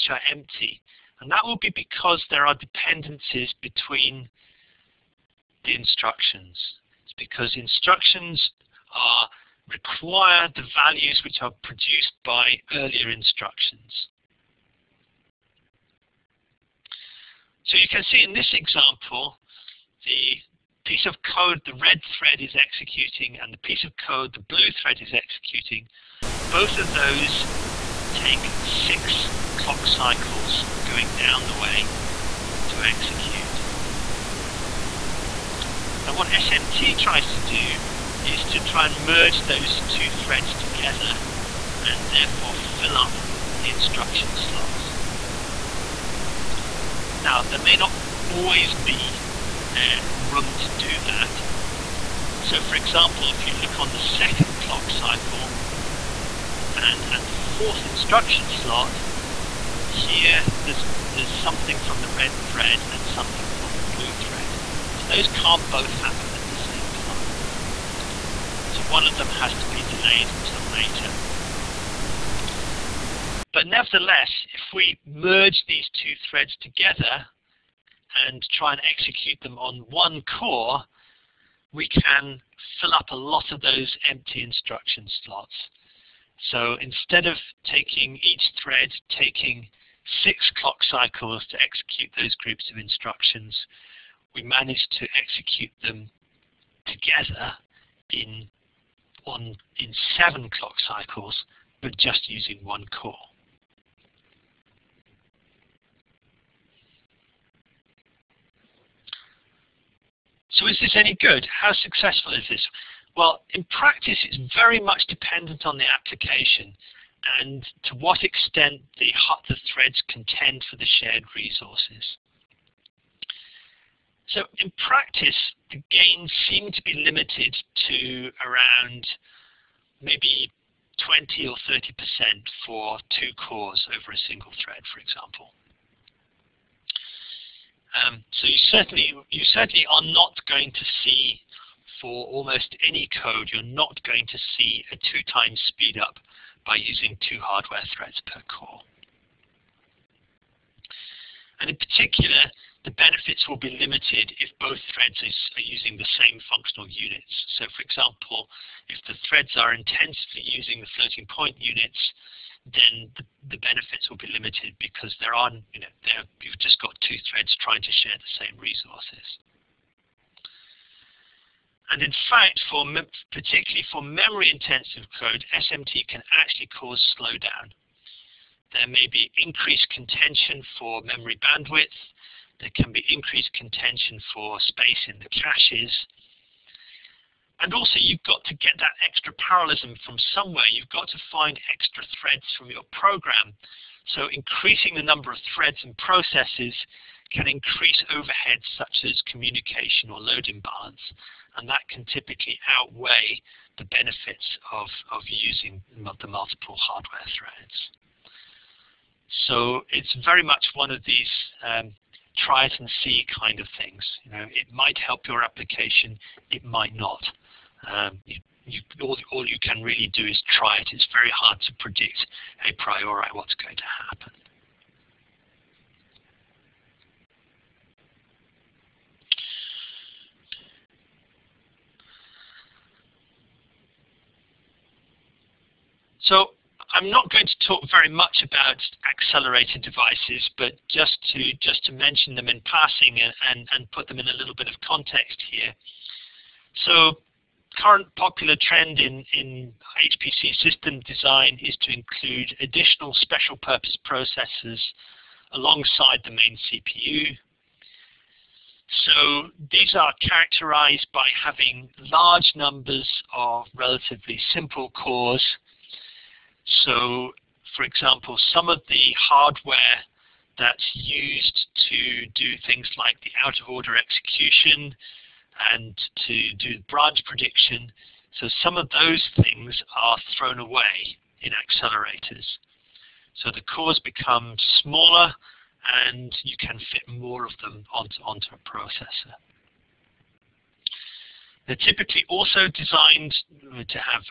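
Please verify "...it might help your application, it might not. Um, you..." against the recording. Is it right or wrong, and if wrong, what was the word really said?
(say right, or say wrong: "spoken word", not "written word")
right.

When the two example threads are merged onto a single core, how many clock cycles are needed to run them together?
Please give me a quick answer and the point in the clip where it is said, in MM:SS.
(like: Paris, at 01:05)
7, at 01:40.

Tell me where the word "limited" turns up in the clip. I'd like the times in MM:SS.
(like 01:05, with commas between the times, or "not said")
02:07, 02:33, 02:44.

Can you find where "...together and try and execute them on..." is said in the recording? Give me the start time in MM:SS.
01:16.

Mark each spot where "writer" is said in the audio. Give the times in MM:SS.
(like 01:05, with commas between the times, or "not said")
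not said.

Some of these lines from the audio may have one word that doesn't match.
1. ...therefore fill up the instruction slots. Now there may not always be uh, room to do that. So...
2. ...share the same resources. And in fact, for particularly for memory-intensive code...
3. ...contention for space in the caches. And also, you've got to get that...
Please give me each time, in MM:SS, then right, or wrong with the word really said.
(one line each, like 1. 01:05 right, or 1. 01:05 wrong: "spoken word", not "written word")
1. 00:42 right
2. 02:47 right
3. 03:03 right.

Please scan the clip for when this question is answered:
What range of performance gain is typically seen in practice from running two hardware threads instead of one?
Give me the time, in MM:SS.
02:11.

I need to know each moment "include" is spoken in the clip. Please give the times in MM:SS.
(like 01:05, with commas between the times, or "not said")
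04:11.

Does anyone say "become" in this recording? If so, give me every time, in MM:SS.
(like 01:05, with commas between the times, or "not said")
04:43.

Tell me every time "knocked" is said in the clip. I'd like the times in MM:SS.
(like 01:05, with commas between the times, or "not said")
not said.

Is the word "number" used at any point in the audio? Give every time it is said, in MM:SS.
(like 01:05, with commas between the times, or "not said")
03:15, 04:22.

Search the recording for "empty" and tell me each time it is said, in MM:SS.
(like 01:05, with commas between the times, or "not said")
00:00, 01:24.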